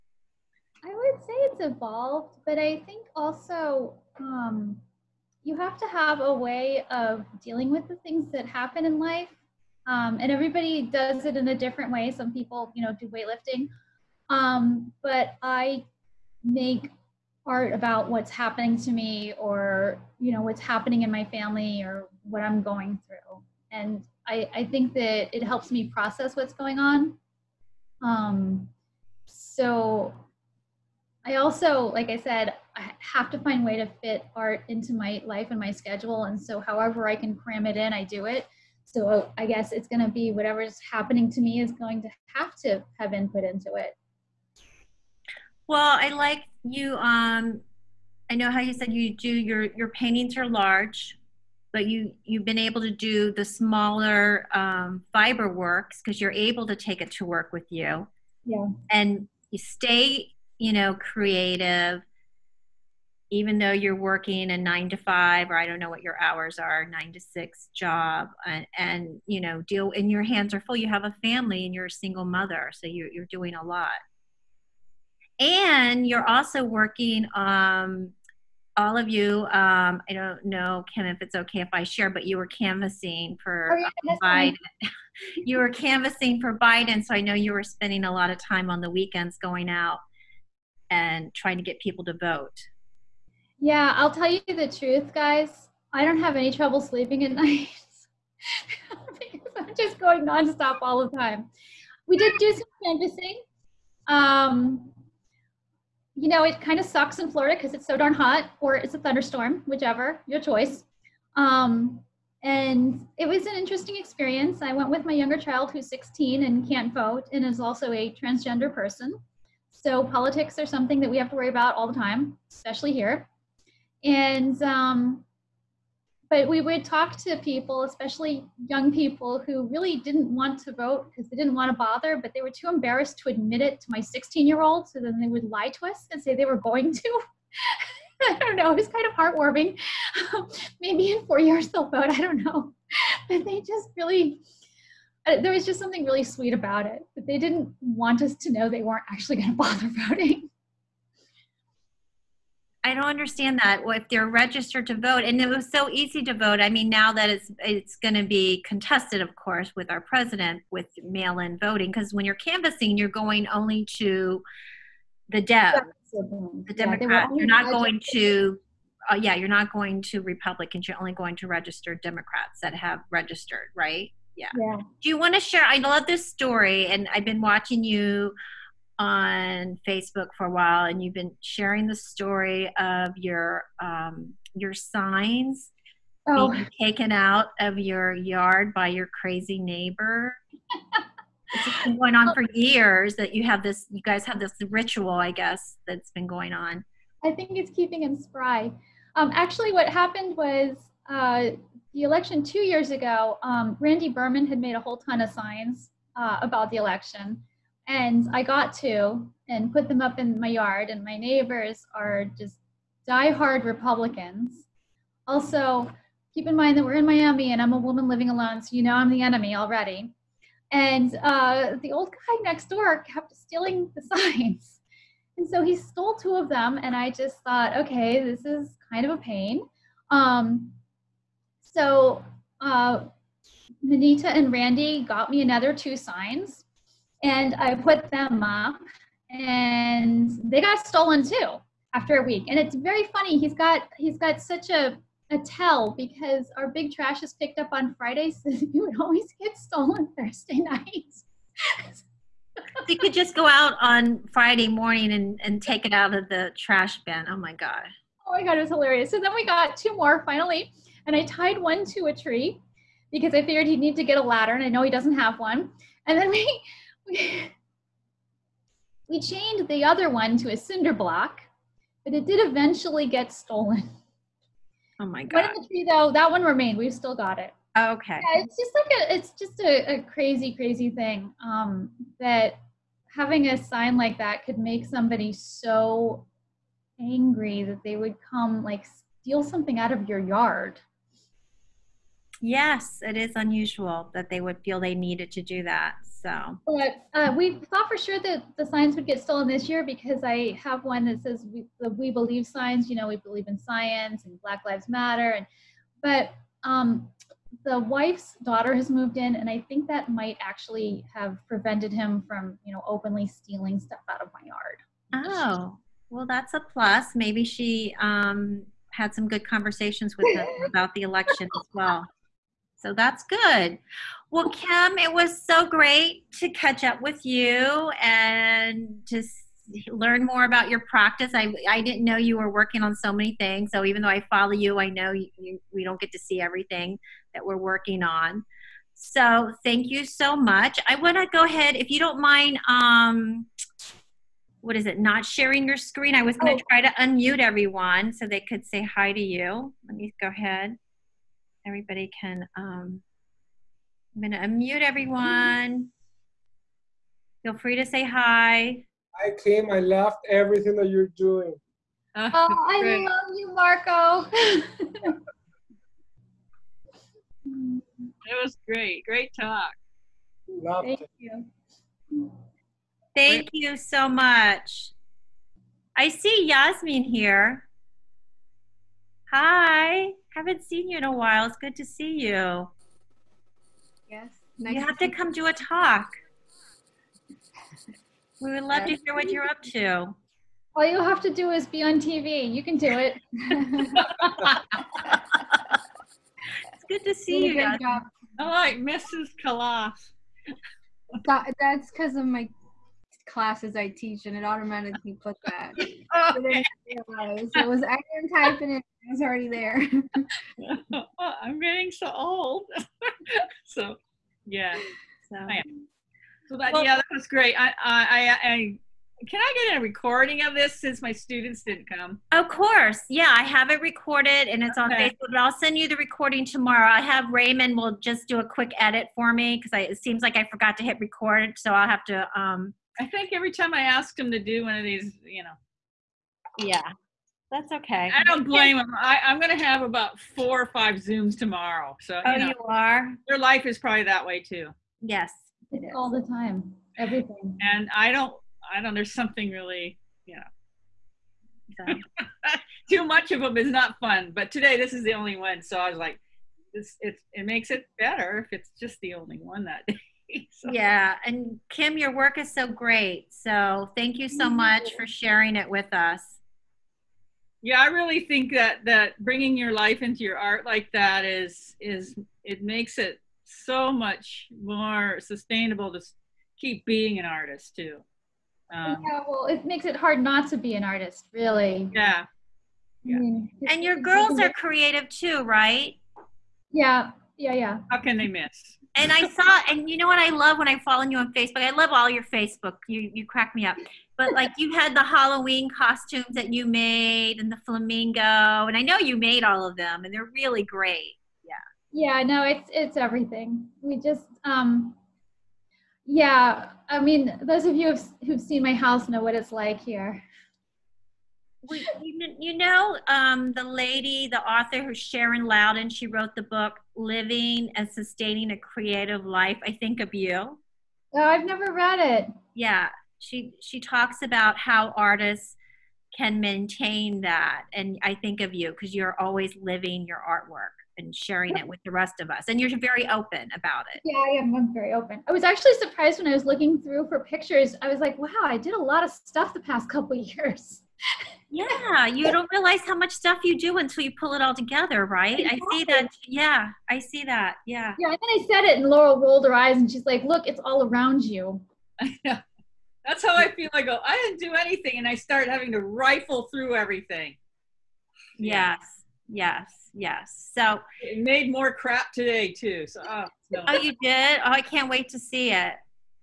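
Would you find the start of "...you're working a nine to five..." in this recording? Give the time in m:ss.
1:03.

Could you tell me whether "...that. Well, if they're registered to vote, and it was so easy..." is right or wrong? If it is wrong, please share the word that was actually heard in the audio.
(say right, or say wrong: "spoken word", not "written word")
right.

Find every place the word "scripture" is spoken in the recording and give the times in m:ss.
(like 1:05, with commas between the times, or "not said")
not said.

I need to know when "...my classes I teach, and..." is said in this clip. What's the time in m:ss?
6:42.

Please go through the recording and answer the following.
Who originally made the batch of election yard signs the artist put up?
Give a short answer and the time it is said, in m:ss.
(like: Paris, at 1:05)
Randy Burman, at 3:23.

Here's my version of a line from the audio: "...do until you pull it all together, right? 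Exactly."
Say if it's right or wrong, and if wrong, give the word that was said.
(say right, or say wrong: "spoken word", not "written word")
right.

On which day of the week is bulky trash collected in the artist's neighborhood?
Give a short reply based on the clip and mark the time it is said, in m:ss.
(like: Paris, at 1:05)
Friday, at 4:07.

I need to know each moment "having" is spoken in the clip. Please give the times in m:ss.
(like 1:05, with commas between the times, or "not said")
4:43, 9:15.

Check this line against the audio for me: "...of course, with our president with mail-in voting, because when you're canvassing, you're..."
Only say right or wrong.
right.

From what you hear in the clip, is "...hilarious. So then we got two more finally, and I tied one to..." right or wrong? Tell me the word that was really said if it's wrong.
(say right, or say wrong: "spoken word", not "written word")
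right.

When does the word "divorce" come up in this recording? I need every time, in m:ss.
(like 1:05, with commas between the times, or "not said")
not said.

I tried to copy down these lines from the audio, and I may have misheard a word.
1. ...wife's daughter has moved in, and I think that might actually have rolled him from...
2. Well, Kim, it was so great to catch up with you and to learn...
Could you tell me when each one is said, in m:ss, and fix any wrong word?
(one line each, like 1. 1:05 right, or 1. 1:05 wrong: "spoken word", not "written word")
1. 5:07 wrong: "prevented", not "rolled"
2. 5:24 right.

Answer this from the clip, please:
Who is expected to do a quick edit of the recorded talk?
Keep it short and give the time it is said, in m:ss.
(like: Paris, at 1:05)
Raymond, at 7:07.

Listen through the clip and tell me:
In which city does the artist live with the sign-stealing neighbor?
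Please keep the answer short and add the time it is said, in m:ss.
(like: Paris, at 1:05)
Miami, at 3:37.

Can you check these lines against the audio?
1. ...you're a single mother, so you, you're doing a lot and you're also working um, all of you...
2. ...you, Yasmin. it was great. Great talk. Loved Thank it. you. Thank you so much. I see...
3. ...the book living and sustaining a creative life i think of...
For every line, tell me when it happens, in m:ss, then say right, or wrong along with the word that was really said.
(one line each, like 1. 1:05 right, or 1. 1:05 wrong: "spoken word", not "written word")
1. 1:11 right
2. 6:03 wrong: "Marco", not "Yasmin"
3. 8:36 right.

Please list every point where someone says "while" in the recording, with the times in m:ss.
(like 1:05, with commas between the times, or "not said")
3:00, 6:21.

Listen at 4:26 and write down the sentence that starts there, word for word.
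And then we we chained the other one to a cinder block, but it did eventually get stolen.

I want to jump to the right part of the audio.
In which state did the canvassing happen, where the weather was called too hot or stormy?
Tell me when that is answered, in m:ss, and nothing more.
1:47.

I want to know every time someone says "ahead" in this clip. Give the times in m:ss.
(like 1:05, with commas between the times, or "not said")
5:41, 5:50.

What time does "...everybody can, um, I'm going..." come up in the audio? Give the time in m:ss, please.
5:51.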